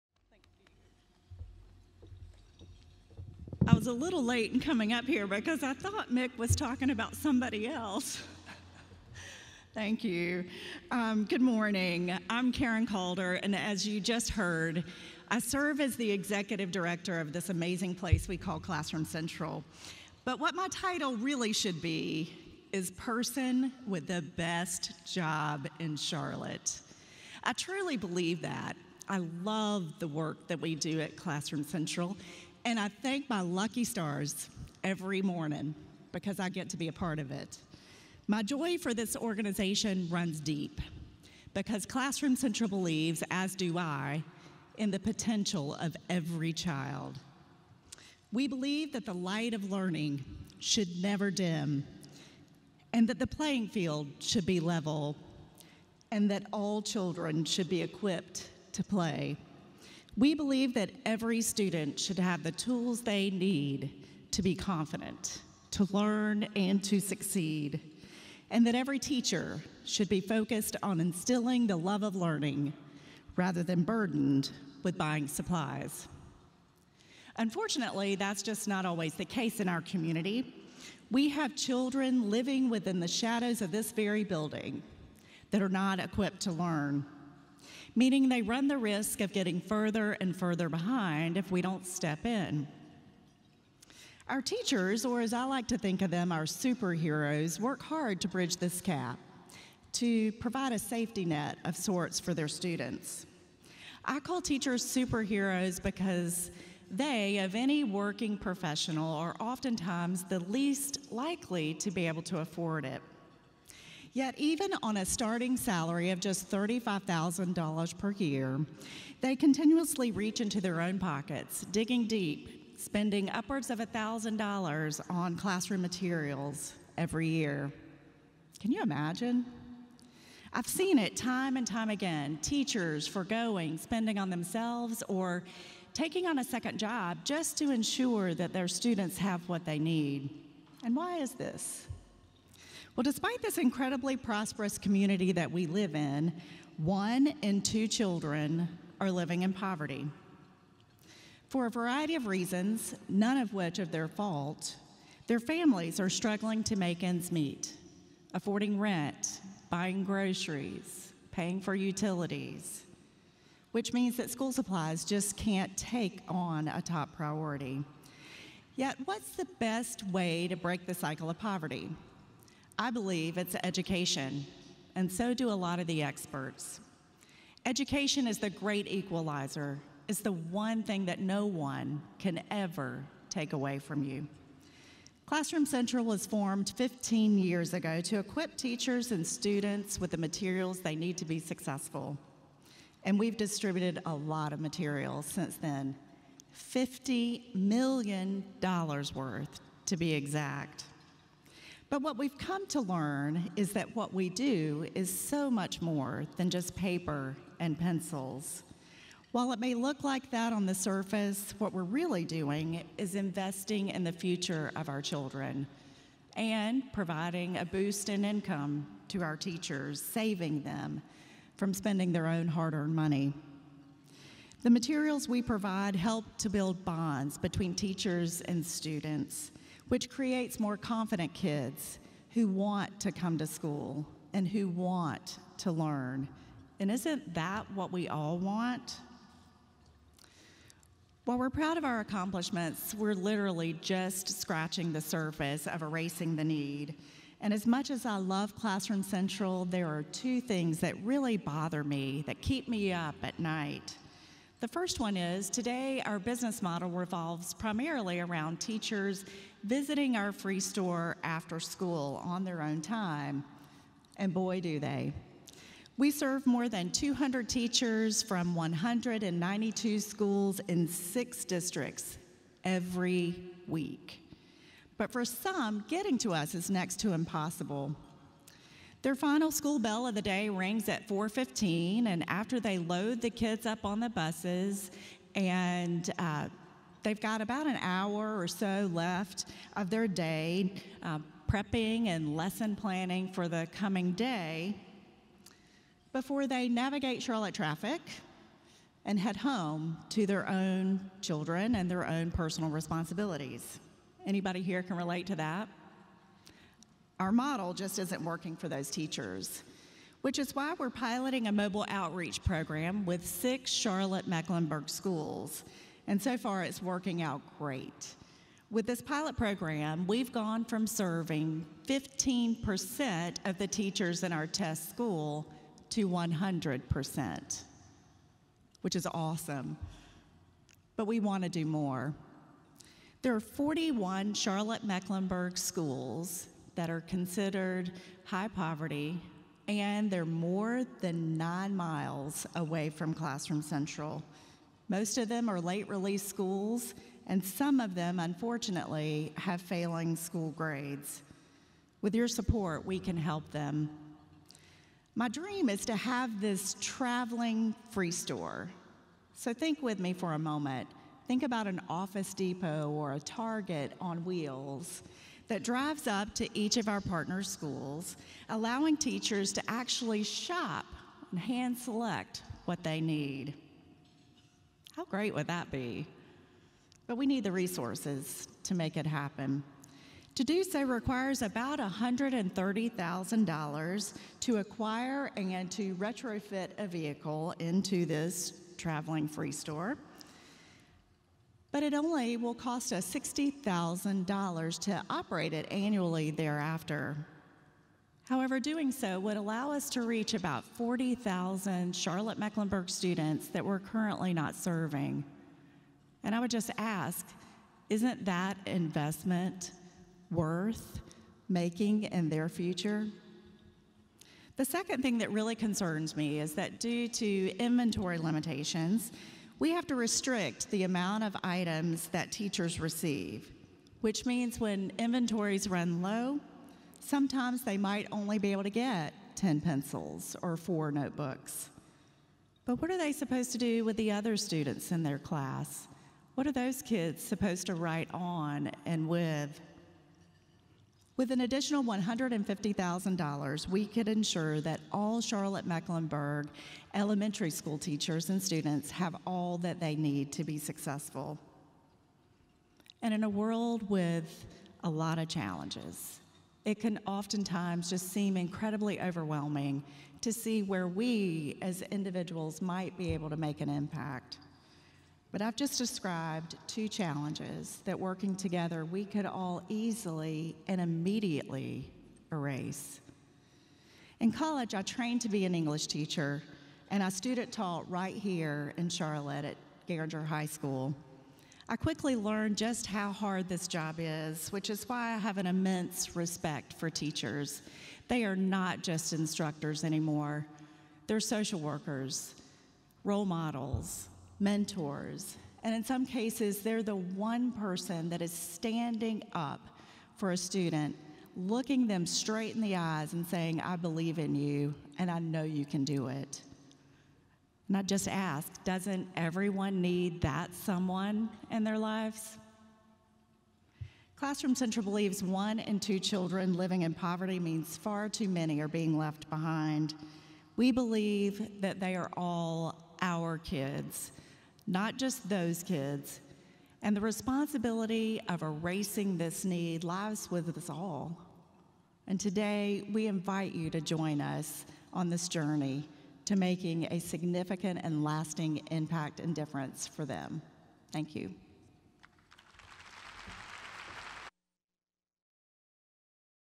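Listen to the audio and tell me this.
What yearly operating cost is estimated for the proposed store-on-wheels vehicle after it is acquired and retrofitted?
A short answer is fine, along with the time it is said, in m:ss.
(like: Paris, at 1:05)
$60,000, at 6:33.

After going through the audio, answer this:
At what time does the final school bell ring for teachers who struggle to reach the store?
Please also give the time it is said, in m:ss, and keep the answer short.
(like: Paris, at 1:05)
4:15, at 4:41.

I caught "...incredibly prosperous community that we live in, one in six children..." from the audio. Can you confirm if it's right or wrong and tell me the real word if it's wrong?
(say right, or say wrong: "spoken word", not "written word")
wrong: "two", not "six".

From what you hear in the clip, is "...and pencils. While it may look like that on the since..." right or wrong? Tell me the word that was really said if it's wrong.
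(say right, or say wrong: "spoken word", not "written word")
wrong: "surface", not "since".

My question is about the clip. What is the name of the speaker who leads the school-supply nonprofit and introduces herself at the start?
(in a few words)
Karen Calder.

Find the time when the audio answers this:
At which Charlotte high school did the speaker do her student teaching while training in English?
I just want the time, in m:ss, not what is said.
7:59.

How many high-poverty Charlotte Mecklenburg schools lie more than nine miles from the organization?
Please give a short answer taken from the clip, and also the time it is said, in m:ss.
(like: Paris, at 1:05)
41, at 5:33.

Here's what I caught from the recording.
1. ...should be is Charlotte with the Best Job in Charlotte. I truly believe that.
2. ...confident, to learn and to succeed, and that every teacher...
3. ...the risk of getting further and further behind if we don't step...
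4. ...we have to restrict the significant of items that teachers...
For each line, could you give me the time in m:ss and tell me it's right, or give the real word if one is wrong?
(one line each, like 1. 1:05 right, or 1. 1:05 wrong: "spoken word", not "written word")
1. 0:21 wrong: "Person", not "Charlotte"
2. 1:04 right
3. 1:28 right
4. 6:59 wrong: "amount", not "significant".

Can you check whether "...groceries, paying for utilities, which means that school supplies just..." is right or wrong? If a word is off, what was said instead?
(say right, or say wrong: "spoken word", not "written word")
right.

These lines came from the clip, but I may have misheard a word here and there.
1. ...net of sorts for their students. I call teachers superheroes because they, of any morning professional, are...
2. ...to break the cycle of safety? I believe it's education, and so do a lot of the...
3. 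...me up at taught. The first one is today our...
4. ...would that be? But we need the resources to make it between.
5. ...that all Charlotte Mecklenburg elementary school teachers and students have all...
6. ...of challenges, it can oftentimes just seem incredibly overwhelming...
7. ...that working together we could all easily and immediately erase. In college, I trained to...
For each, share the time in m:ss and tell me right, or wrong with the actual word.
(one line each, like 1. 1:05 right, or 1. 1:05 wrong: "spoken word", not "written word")
1. 1:41 wrong: "working", not "morning"
2. 2:50 wrong: "poverty", not "safety"
3. 4:12 wrong: "night", not "taught"
4. 6:15 wrong: "happen", not "between"
5. 7:24 right
6. 7:35 right
7. 7:47 right.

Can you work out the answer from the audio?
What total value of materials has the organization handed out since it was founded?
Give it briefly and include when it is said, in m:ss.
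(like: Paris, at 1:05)
$50 million, at 3:16.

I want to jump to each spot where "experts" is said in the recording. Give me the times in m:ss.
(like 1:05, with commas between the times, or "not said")
2:56.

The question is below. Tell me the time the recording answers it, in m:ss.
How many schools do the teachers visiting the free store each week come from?
4:28.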